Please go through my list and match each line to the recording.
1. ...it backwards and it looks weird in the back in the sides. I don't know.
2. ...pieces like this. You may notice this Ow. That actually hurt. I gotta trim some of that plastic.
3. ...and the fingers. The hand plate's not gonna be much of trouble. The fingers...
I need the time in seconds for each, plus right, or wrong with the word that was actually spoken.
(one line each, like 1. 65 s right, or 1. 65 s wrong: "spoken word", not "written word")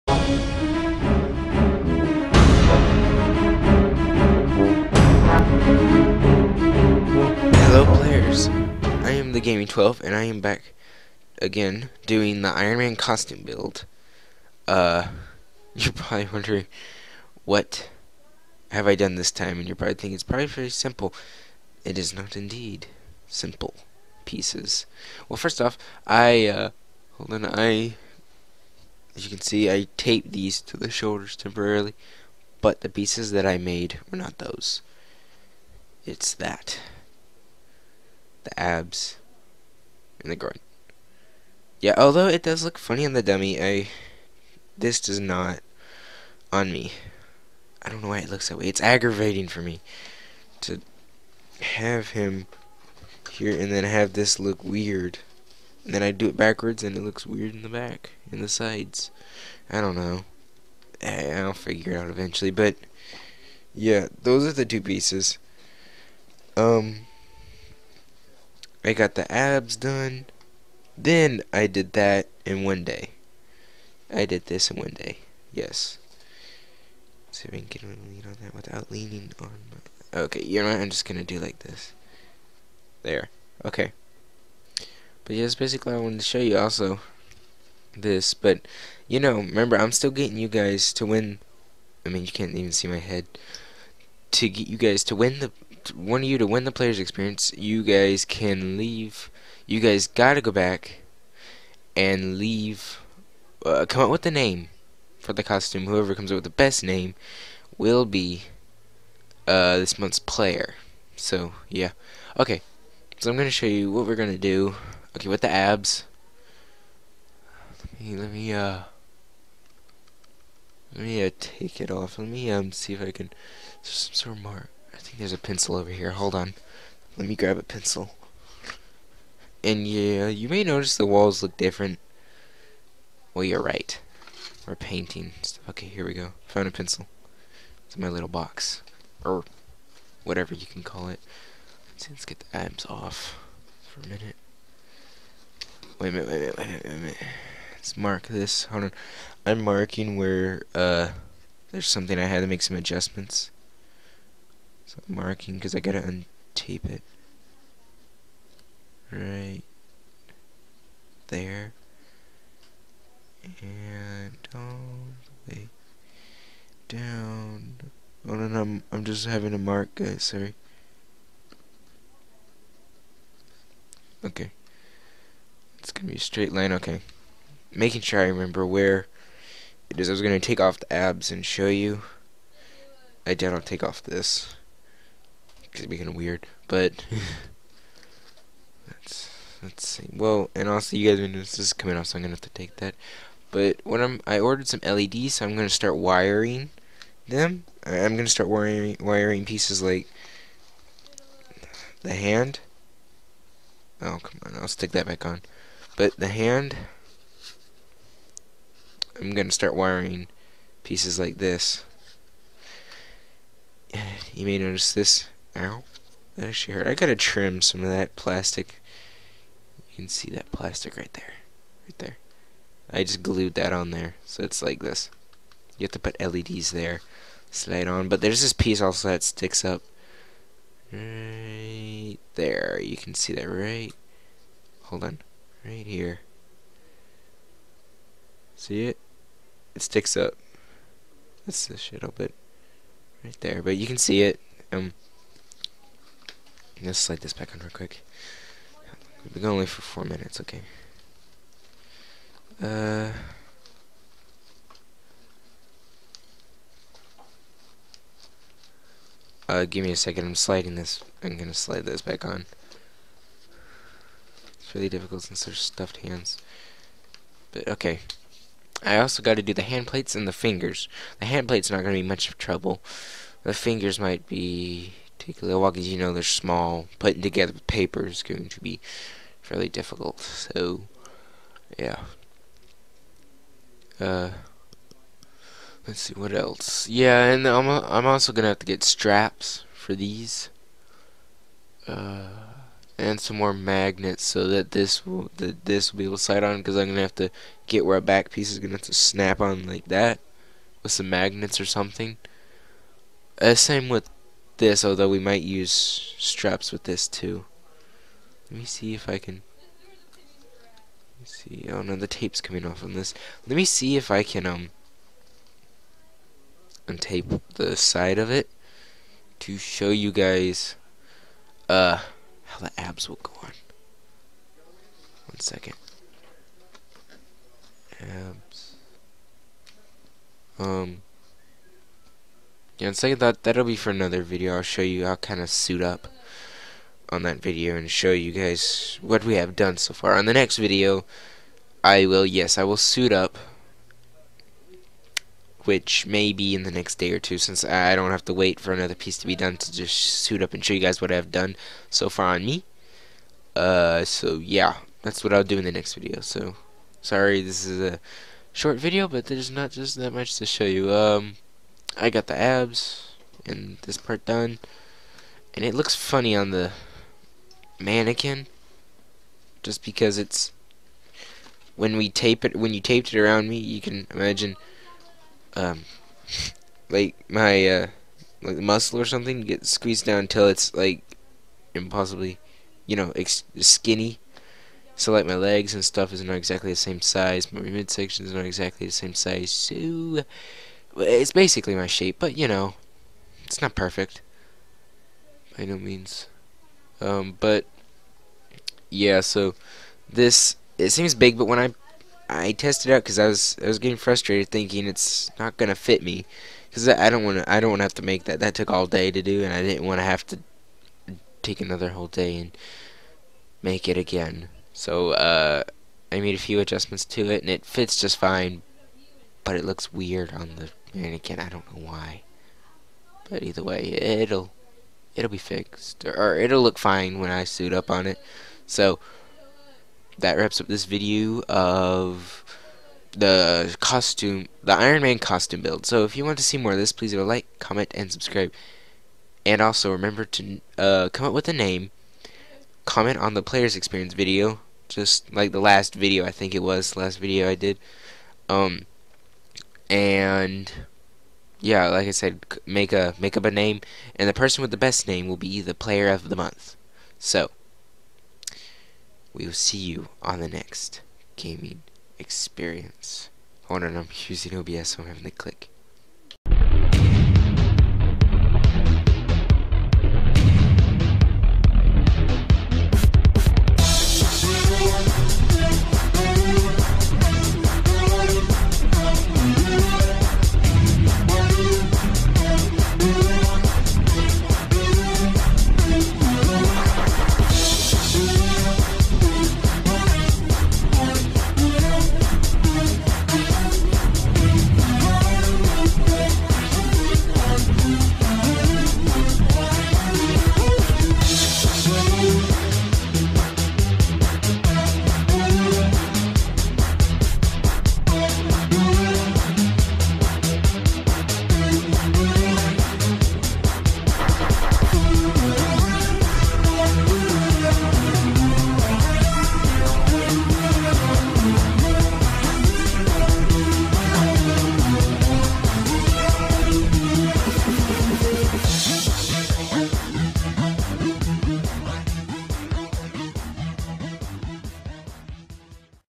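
1. 56 s right
2. 210 s right
3. 270 s right.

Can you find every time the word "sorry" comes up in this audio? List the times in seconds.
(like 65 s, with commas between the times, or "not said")
170 s, 357 s.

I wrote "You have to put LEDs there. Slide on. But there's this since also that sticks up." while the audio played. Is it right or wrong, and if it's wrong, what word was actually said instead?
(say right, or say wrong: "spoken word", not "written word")
wrong: "piece", not "since".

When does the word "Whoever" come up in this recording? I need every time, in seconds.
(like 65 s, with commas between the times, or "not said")
105 s.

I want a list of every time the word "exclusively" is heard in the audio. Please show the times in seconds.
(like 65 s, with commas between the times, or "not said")
not said.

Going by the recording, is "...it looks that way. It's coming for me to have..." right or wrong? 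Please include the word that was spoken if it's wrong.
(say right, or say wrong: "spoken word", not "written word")
wrong: "aggravating", not "coming".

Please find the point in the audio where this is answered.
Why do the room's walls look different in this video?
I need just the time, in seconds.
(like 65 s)
134 s.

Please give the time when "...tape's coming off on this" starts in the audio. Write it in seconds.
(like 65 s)
312 s.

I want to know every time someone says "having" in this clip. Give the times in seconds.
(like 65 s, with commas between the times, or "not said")
169 s, 465 s.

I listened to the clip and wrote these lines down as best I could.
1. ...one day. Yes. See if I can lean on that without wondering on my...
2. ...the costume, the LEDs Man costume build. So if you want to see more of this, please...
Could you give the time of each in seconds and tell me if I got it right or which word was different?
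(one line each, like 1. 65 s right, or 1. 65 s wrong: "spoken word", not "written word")
1. 74 s wrong: "leaning", not "wondering"
2. 433 s wrong: "Iron", not "LEDs".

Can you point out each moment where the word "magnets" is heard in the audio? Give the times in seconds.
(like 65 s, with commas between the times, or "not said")
293 s, 301 s.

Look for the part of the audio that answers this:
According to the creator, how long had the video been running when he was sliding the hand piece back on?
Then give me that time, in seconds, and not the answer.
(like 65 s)
249 s.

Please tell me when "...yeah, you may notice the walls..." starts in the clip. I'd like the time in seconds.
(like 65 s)
129 s.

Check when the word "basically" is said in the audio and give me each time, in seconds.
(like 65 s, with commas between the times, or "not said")
85 s, 391 s.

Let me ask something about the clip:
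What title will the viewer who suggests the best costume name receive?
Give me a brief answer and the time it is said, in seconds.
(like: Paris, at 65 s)
Player of the month, at 455 s.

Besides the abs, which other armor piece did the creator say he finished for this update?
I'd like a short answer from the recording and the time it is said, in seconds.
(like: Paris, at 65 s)
The groin, at 40 s.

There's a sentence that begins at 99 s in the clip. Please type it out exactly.
You guys gotta go back and leave.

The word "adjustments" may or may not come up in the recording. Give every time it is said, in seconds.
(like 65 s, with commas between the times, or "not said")
152 s, 416 s.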